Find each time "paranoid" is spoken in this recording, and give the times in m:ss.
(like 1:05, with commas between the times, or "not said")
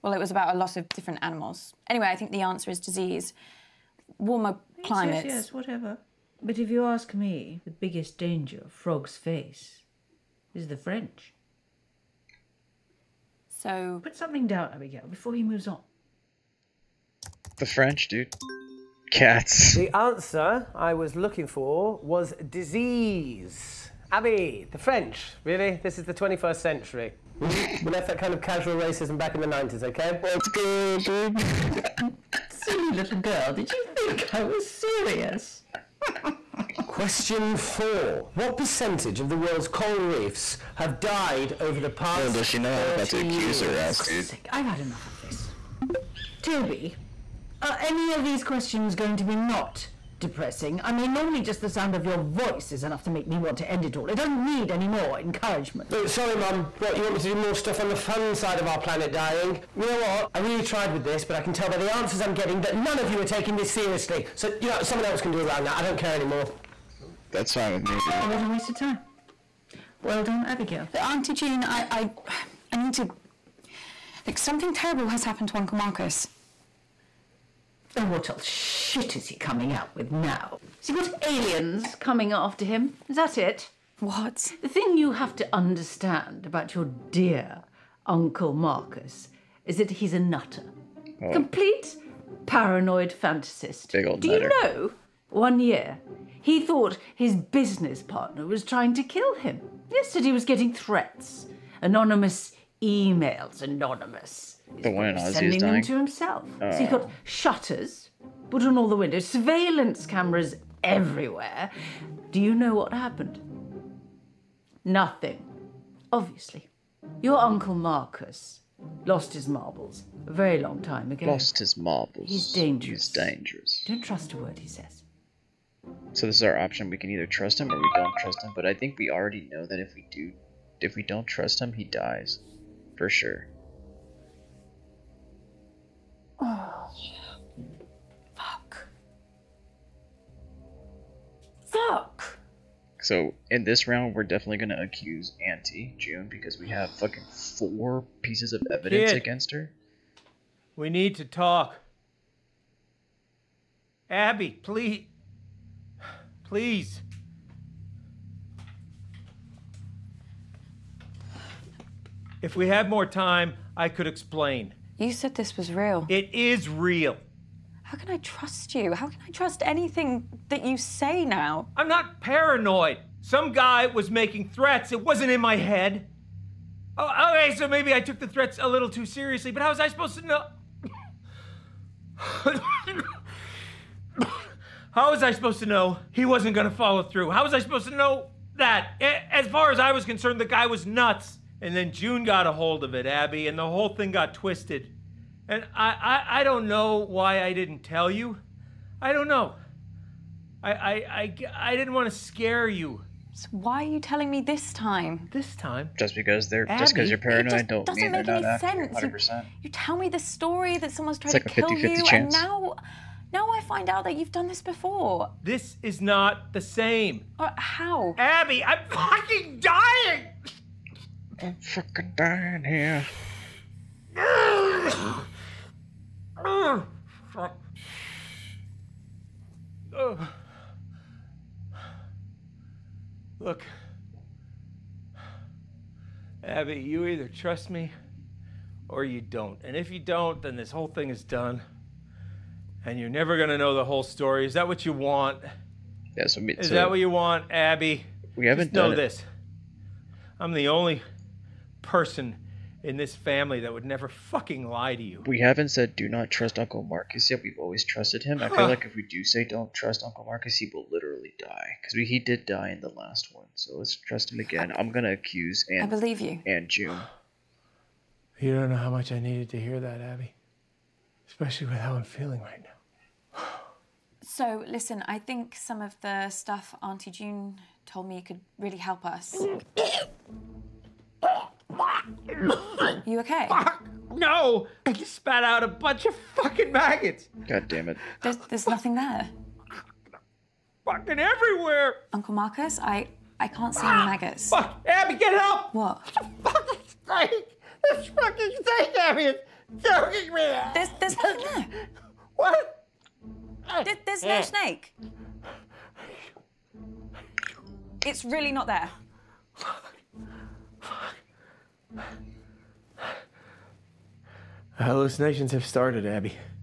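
1:32, 2:52, 3:27.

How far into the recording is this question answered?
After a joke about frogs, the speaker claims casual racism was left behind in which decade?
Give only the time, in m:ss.
0:29.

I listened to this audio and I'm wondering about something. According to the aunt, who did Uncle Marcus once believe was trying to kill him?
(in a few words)
his business partner.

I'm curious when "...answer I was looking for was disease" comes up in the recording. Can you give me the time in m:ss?
0:19.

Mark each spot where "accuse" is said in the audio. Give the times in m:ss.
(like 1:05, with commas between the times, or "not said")
0:43, 2:24, 4:25.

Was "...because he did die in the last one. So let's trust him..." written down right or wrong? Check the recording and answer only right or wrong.
right.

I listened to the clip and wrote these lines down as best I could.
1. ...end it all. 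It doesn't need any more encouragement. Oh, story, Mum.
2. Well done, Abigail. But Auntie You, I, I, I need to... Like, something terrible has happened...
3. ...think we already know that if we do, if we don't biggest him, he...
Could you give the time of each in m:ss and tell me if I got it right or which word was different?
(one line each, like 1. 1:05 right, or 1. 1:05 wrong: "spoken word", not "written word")
1. 0:53 wrong: "sorry", not "story"
2. 1:10 wrong: "June", not "You"
3. 2:08 wrong: "trust", not "biggest".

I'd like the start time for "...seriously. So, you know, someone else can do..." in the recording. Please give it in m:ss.
1:03.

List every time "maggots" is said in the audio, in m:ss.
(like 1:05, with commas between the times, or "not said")
4:46, 4:54.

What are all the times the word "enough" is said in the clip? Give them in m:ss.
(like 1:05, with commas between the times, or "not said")
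0:44, 0:52.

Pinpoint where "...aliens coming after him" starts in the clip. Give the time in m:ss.
1:21.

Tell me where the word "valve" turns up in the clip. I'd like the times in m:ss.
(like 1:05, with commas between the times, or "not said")
not said.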